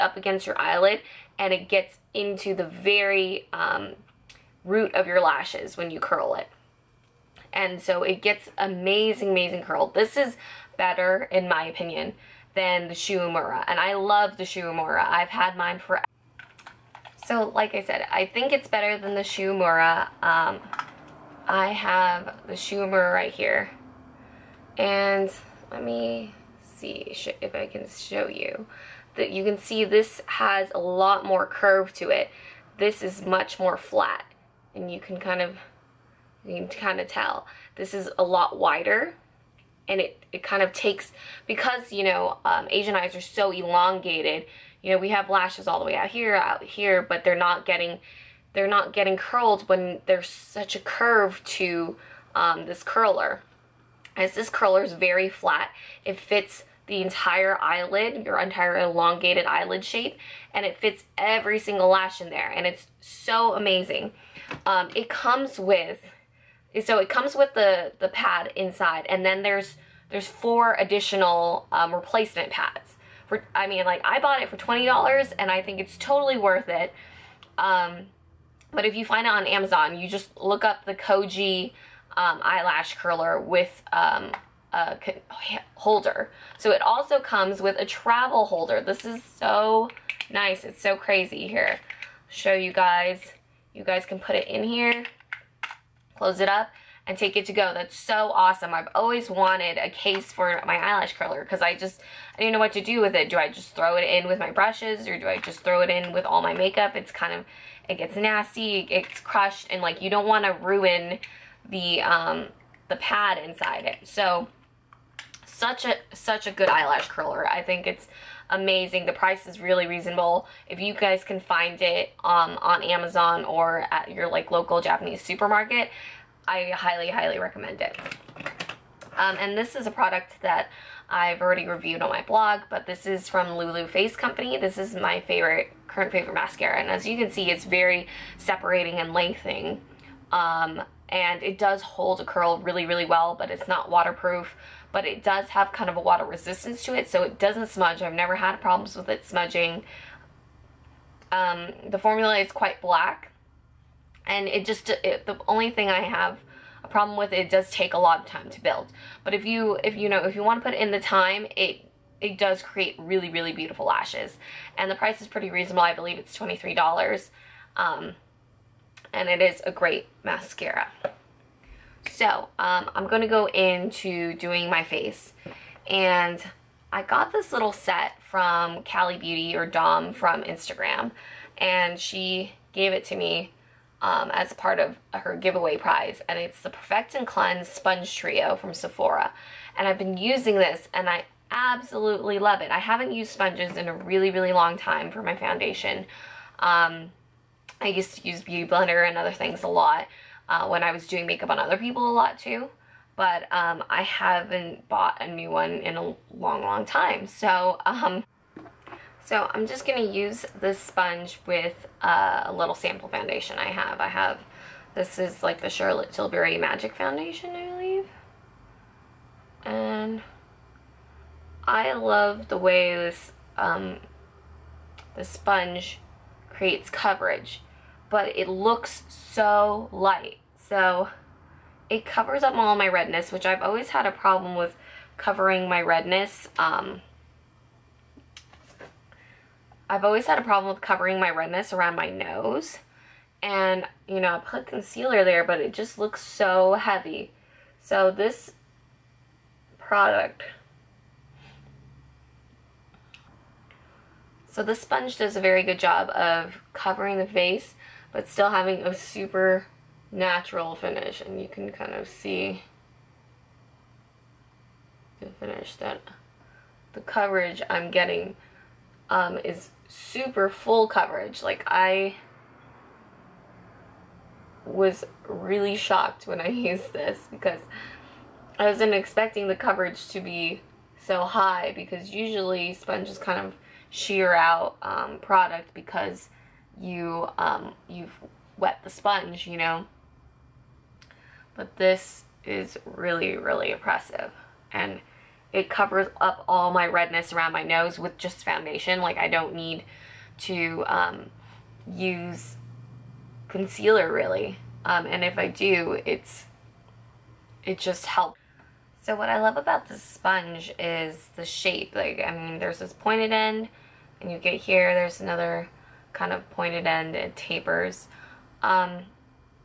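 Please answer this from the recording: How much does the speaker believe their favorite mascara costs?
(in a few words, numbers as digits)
$23.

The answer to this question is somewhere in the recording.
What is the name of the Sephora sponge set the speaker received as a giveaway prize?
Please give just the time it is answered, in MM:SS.
03:06.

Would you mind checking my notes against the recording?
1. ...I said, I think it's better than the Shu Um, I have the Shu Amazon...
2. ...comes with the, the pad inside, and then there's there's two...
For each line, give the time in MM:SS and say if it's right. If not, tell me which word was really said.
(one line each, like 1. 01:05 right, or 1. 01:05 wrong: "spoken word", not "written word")
1. 00:17 wrong: "Uemura", not "Amazon"
2. 01:07 wrong: "four", not "two".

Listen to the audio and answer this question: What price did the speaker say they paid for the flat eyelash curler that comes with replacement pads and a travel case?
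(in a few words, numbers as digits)
$20.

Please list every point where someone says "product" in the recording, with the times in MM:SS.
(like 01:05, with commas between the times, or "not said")
02:09, 04:09, 04:45.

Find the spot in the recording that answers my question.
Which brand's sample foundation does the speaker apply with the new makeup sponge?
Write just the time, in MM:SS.
03:35.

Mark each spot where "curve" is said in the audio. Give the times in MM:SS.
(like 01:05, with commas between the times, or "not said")
00:31, 00:50.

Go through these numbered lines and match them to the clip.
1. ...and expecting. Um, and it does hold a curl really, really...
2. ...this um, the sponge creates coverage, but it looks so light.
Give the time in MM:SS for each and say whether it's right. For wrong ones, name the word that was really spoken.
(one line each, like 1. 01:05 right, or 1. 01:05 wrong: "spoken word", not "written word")
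1. 02:18 wrong: "lengthening", not "expecting"
2. 03:42 right.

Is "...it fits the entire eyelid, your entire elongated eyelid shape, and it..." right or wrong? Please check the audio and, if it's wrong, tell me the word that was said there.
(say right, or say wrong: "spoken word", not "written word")
right.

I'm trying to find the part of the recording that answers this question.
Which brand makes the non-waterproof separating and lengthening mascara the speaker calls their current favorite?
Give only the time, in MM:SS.
02:13.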